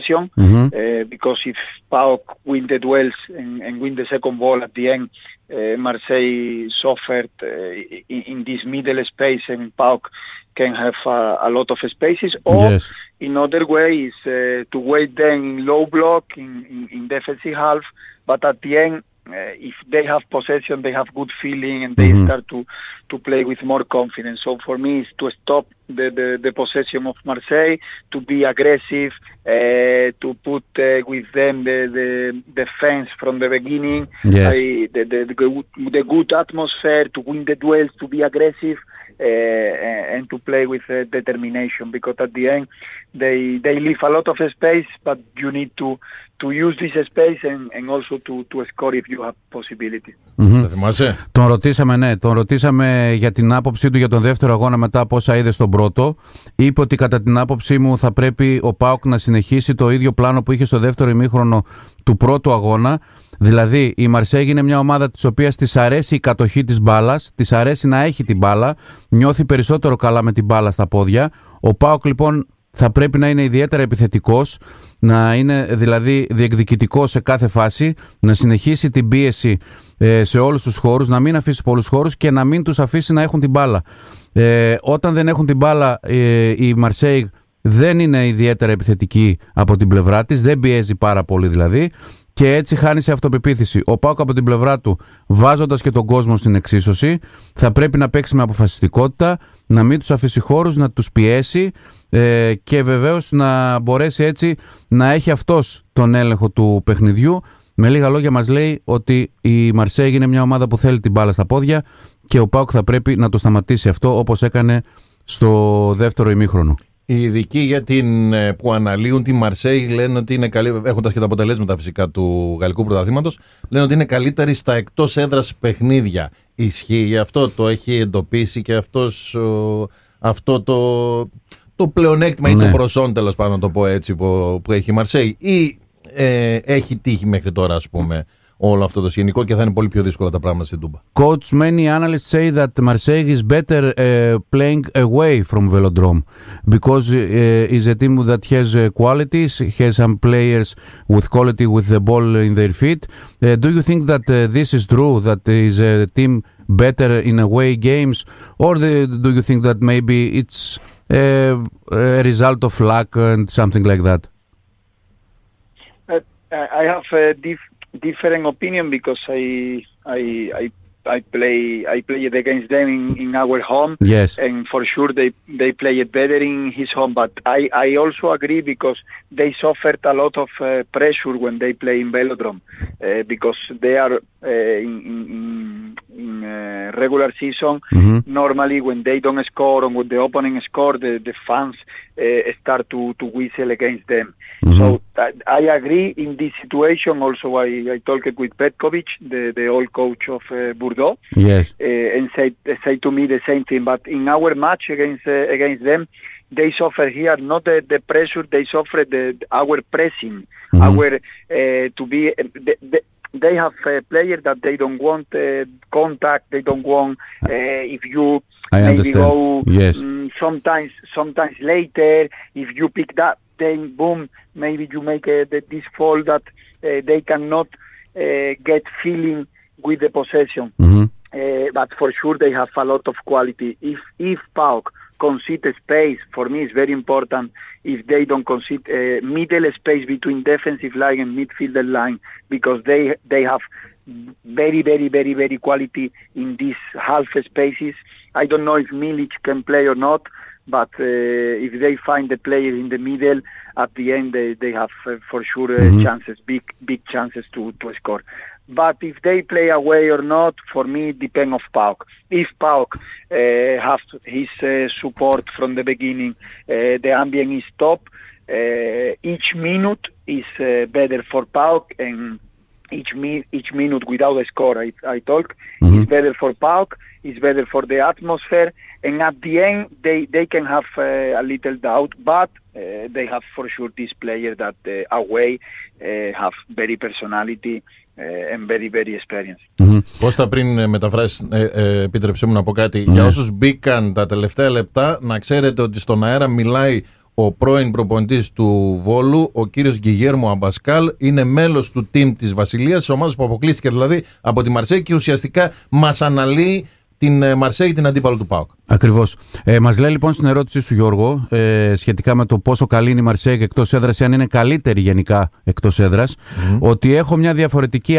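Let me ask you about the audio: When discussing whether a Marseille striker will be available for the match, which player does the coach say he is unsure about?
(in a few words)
Milik.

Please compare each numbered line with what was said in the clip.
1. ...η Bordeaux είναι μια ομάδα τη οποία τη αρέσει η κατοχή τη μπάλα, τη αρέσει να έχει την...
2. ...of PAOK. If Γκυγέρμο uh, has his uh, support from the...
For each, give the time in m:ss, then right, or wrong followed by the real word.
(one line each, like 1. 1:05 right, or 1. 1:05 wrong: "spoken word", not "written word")
1. 1:03 wrong: "Μαρσέγ", not "Bordeaux"
2. 4:21 wrong: "PAOK", not "Γκυγέρμο".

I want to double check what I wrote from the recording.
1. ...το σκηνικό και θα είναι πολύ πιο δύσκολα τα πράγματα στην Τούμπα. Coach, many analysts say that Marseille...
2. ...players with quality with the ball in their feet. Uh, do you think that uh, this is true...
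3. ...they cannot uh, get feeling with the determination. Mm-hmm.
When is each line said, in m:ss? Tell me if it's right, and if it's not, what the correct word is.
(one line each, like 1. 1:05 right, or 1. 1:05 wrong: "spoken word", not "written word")
1. 2:19 right
2. 2:30 right
3. 3:47 wrong: "possession", not "determination".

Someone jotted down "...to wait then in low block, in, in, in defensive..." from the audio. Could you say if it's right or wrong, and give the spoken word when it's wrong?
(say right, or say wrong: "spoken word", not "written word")
right.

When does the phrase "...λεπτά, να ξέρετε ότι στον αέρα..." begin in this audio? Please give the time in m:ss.
4:54.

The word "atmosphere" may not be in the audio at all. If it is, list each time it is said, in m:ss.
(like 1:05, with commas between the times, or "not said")
0:36, 4:38.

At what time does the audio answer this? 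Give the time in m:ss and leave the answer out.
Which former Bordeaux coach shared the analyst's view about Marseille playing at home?
3:18.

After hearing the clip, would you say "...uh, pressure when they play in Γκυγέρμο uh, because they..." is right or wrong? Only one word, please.
wrong.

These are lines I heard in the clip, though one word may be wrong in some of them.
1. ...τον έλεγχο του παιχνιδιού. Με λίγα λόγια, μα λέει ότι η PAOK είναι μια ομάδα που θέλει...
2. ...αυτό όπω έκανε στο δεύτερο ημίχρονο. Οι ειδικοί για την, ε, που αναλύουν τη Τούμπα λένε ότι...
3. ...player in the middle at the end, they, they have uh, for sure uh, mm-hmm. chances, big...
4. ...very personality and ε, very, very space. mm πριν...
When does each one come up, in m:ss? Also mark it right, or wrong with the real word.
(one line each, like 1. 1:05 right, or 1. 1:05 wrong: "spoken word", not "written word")
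1. 1:45 wrong: "Μαρσέη", not "PAOK"
2. 1:53 wrong: "Μαρσέη", not "Τούμπα"
3. 4:12 right
4. 4:46 wrong: "experience", not "space".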